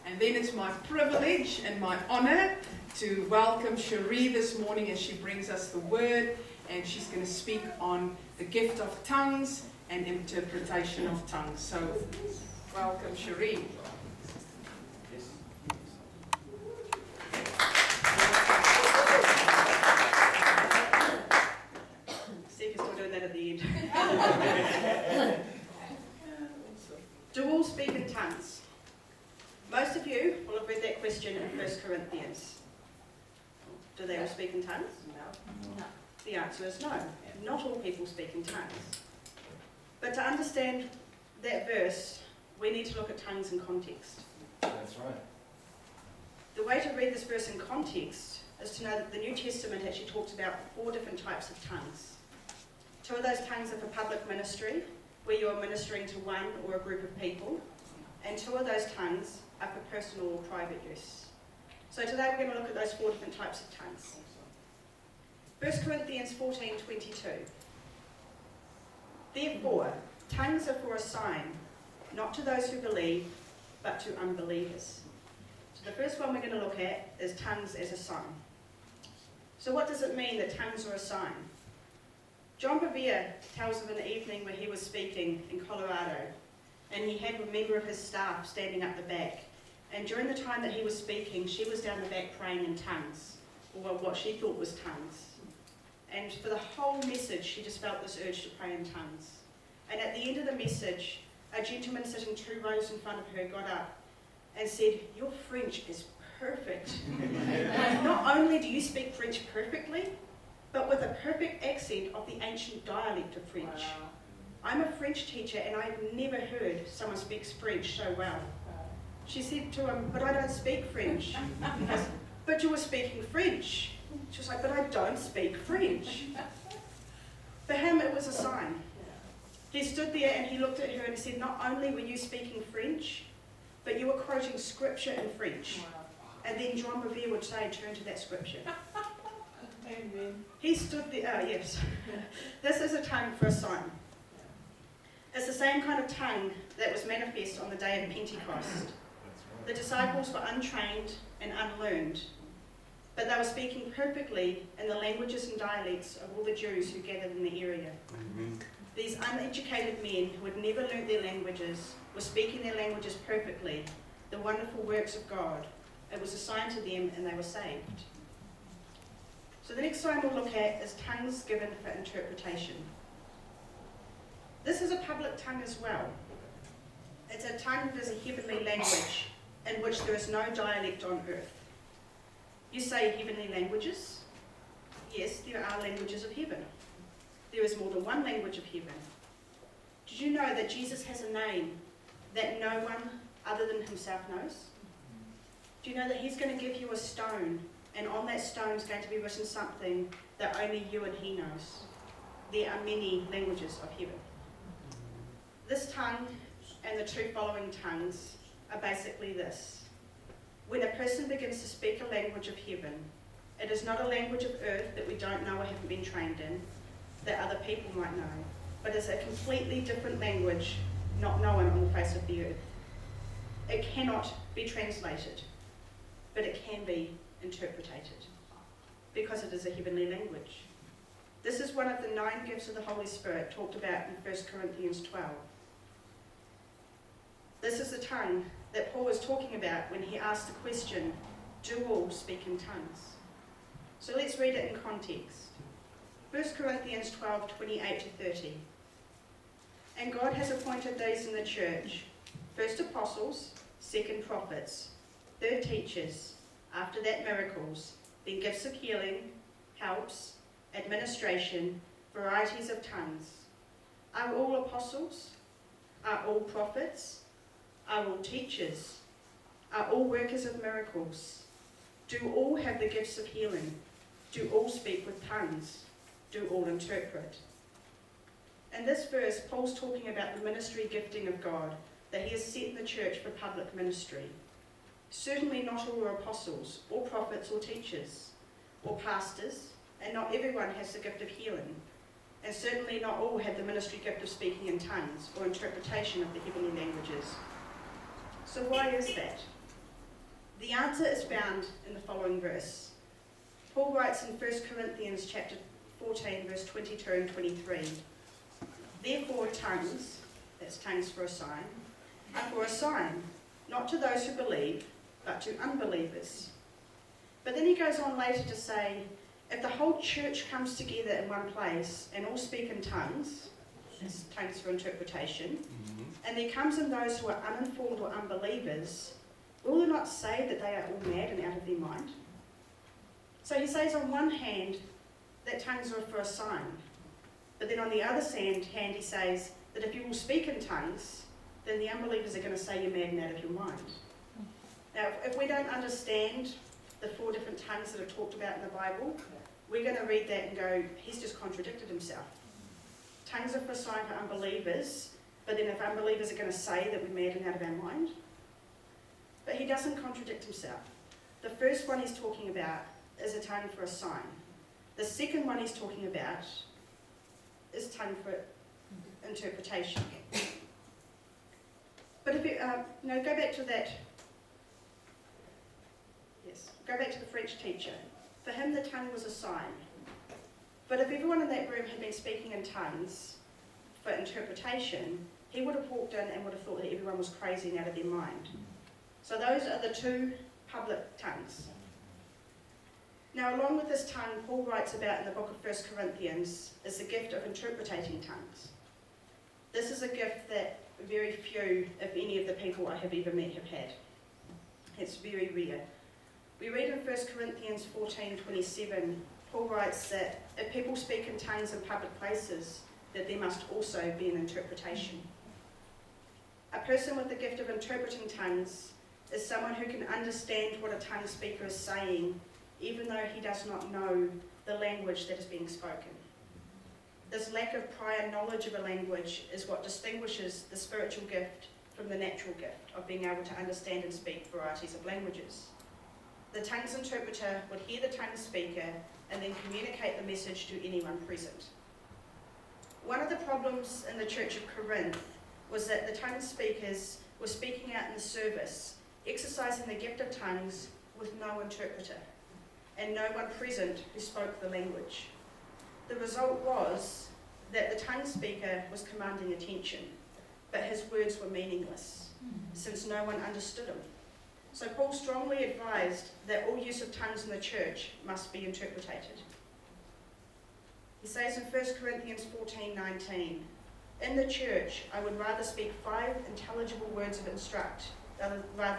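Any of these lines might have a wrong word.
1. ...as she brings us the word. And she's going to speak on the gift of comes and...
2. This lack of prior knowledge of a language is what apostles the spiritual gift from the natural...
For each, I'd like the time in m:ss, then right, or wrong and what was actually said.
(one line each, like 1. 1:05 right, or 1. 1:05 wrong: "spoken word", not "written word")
1. 0:04 wrong: "tongues", not "comes"
2. 7:07 wrong: "distinguishes", not "apostles".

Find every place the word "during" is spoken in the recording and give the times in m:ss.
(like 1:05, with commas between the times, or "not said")
1:30.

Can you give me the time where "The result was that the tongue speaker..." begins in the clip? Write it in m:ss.
7:36.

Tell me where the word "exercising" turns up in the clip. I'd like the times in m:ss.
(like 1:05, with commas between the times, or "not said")
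7:29.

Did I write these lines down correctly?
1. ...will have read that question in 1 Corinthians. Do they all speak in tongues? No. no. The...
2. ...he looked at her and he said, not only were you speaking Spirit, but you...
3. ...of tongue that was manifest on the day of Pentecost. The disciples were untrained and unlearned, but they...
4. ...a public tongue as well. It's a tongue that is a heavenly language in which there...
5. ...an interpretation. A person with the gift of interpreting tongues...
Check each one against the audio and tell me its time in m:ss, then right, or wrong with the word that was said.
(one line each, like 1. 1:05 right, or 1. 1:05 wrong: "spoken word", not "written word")
1. 0:30 right
2. 2:10 wrong: "French", not "Spirit"
3. 2:26 right
4. 2:54 right
5. 6:54 right.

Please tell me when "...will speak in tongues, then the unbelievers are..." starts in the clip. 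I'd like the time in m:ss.
5:40.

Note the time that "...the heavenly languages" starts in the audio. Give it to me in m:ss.
4:56.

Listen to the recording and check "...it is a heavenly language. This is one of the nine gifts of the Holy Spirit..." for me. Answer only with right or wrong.
right.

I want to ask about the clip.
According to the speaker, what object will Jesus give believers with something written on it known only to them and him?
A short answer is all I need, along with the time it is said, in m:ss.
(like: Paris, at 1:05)
A stone, at 3:16.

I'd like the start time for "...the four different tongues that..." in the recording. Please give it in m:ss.
5:46.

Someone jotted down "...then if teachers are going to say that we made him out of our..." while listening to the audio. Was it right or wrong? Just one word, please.
wrong.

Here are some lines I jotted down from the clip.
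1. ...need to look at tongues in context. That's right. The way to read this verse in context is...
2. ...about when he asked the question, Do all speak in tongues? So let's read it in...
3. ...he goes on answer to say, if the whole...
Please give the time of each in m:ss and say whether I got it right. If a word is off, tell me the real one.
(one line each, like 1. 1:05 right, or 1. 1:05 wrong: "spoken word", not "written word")
1. 0:42 right
2. 3:59 right
3. 5:17 wrong: "later", not "answer".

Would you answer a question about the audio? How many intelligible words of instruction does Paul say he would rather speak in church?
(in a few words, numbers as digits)
5.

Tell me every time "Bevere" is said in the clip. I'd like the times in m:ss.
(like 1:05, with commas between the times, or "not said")
1:22, 2:17.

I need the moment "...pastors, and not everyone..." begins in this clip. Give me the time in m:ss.
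4:49.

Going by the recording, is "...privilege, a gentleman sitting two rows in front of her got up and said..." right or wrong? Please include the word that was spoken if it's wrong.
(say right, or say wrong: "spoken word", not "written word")
wrong: "message", not "privilege".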